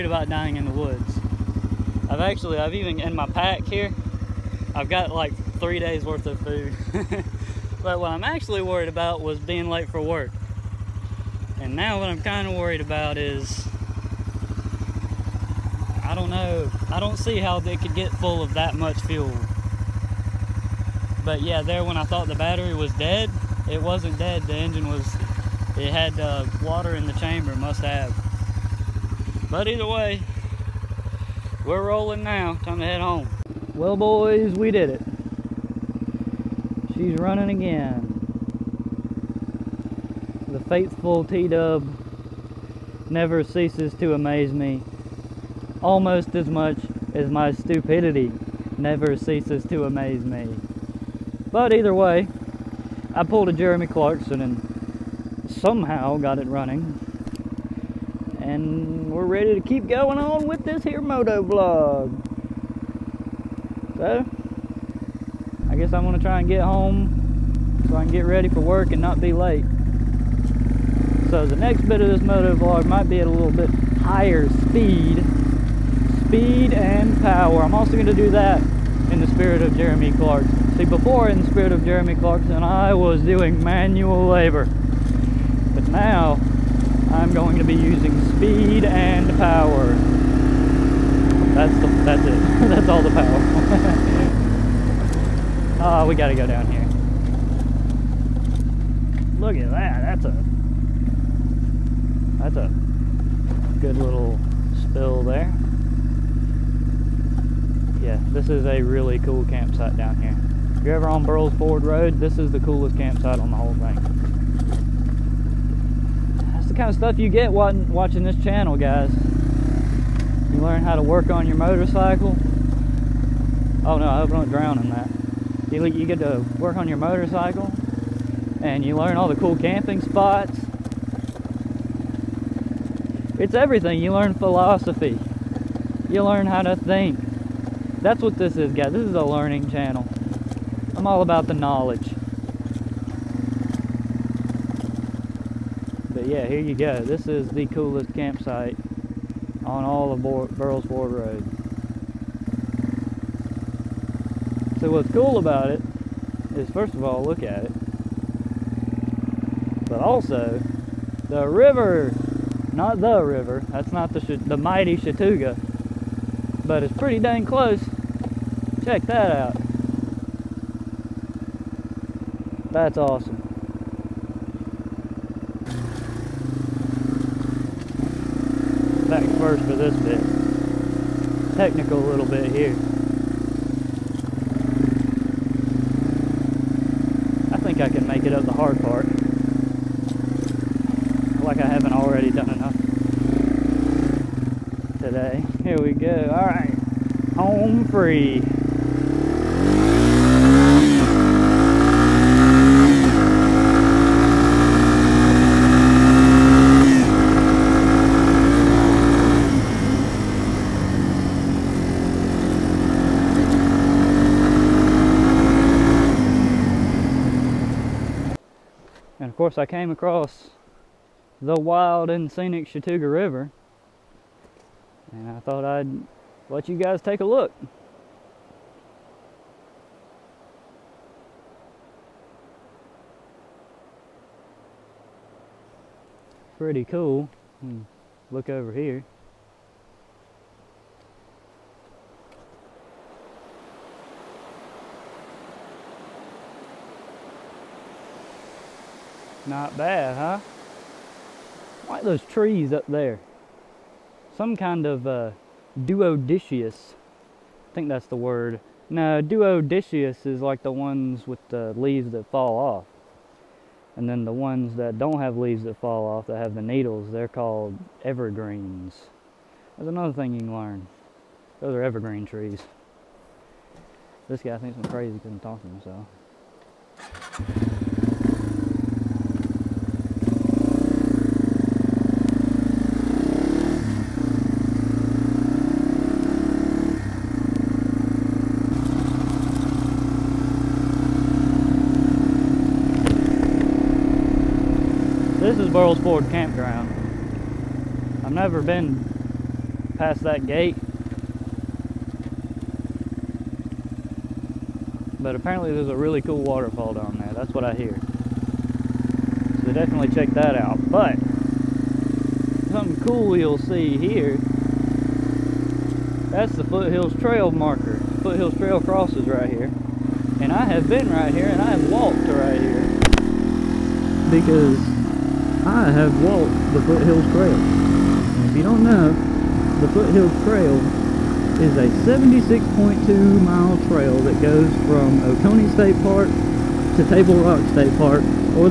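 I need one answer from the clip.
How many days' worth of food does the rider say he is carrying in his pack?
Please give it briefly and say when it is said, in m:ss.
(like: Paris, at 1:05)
3, at 0:05.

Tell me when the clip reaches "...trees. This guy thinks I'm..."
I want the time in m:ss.
4:32.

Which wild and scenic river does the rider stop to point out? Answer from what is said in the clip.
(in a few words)
Chattooga River.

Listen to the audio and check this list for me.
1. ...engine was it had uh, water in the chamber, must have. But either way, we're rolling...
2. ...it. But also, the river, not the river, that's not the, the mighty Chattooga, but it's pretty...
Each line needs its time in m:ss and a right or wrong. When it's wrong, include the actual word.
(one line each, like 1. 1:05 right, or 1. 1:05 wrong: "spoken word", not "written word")
1. 0:24 right
2. 2:37 right.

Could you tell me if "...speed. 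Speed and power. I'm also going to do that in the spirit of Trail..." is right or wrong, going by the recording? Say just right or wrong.
wrong.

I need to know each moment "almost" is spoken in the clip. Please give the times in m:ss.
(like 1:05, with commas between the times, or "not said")
0:45.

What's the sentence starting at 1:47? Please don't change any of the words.
Yeah, this is a really cool campsite down here.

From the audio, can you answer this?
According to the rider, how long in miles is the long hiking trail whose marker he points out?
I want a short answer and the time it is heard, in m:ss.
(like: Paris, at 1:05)
76.2 miles, at 5:32.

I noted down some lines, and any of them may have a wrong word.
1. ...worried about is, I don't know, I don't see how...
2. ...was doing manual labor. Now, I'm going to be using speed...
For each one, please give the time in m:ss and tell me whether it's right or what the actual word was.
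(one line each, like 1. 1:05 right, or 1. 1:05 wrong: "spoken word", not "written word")
1. 0:12 right
2. 1:22 right.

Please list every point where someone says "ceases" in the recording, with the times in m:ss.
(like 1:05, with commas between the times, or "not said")
0:43, 0:49.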